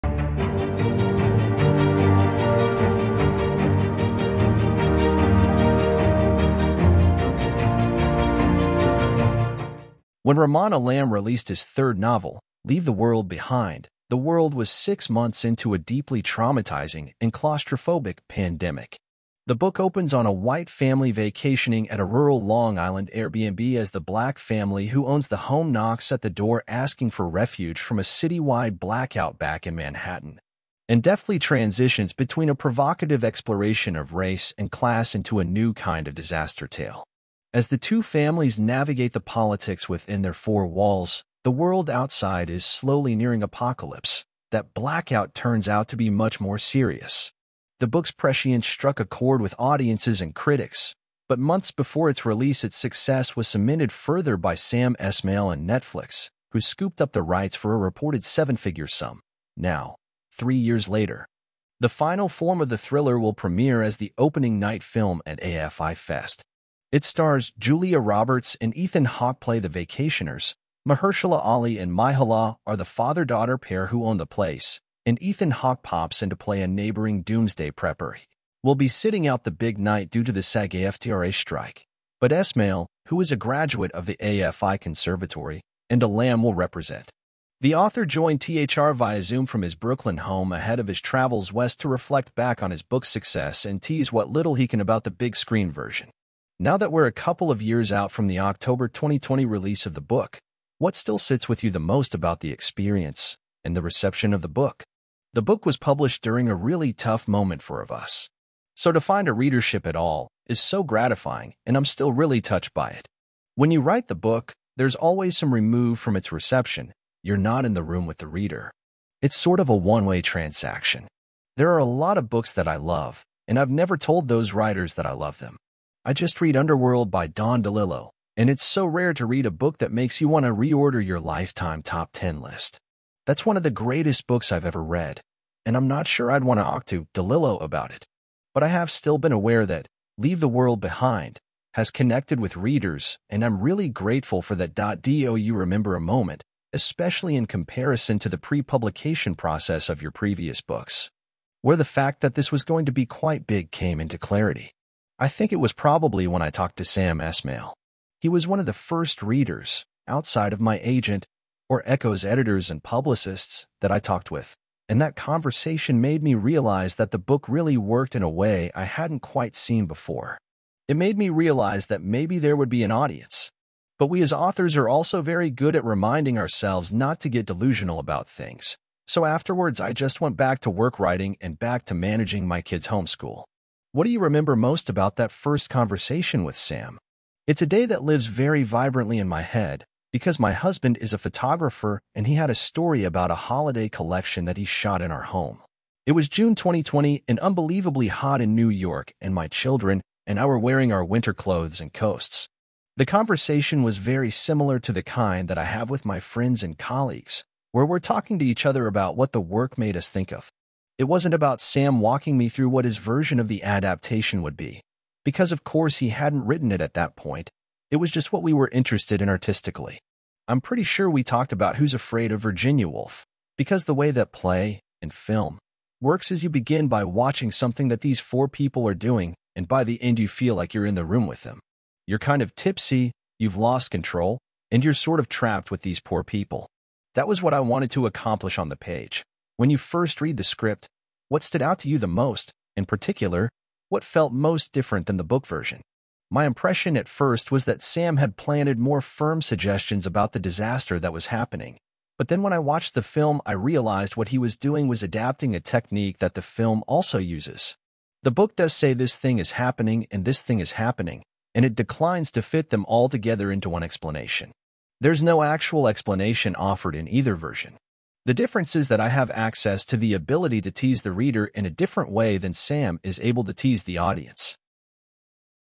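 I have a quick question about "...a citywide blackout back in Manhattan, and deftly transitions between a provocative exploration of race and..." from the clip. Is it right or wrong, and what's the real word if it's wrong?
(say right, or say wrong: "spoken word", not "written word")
right.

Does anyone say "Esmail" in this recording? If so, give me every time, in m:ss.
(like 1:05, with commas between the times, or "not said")
0:54, 1:22, 2:37.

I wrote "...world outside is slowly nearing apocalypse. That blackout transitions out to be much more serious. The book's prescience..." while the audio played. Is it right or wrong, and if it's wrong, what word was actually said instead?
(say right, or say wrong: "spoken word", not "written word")
wrong: "turns", not "transitions".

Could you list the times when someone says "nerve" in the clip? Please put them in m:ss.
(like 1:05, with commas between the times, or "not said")
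not said.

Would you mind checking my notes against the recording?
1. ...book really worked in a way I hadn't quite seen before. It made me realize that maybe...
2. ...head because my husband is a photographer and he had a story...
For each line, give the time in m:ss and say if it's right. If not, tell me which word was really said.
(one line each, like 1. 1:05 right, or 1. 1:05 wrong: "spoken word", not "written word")
1. 2:47 right
2. 3:09 right.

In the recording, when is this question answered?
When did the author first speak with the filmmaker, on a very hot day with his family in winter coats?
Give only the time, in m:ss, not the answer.
3:16.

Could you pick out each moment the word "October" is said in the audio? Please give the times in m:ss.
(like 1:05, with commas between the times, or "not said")
1:38.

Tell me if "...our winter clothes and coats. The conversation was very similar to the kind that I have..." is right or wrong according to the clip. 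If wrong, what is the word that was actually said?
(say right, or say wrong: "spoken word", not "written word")
right.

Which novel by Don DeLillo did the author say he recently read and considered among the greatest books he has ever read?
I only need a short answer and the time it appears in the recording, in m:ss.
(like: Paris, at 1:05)
Underworld, at 2:06.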